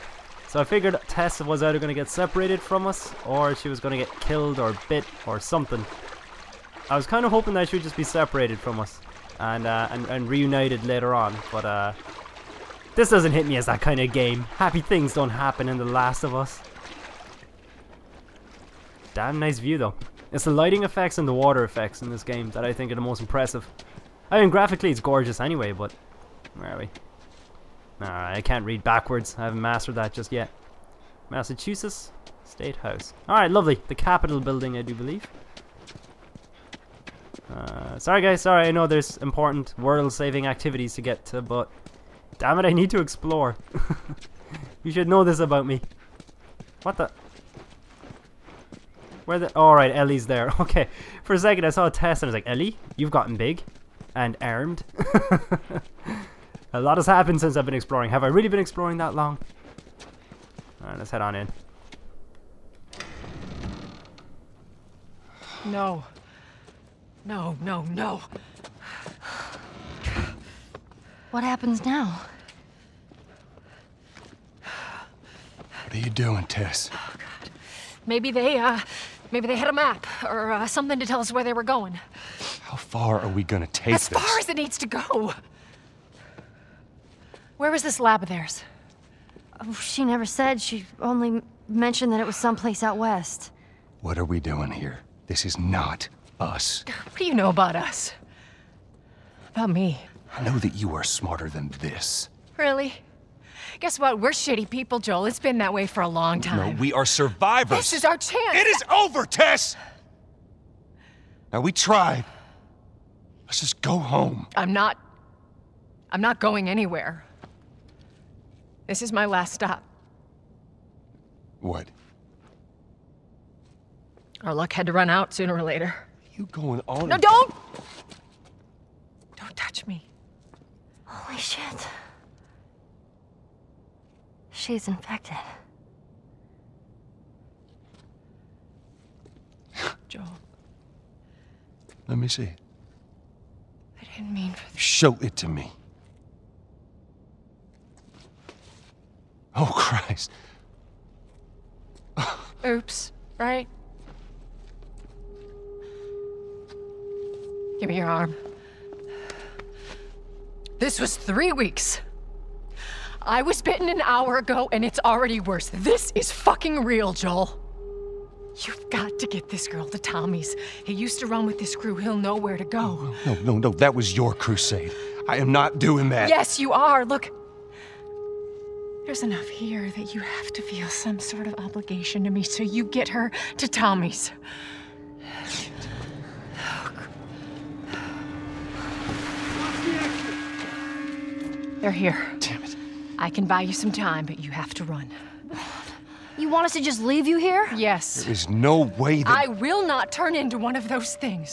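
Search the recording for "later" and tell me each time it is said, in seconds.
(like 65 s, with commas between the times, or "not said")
10 s, 125 s.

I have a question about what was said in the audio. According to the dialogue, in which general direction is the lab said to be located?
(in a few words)
Out west.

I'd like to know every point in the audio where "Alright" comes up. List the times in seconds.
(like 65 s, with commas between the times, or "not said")
28 s, 33 s, 49 s, 60 s.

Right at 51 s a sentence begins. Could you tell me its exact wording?
For a second, I saw a Tess and I was like, Ellie, you've gotten big and armed.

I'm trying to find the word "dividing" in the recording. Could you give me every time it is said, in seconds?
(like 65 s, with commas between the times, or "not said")
not said.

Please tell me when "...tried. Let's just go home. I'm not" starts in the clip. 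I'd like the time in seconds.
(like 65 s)
111 s.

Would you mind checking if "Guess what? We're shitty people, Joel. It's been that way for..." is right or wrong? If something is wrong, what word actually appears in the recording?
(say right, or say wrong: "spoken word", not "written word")
right.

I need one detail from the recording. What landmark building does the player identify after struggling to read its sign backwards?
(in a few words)
Massachusetts State House.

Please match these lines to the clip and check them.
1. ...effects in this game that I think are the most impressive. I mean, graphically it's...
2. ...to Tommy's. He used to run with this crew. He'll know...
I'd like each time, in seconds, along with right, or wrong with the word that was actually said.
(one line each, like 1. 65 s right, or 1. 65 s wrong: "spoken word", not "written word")
1. 21 s right
2. 169 s right.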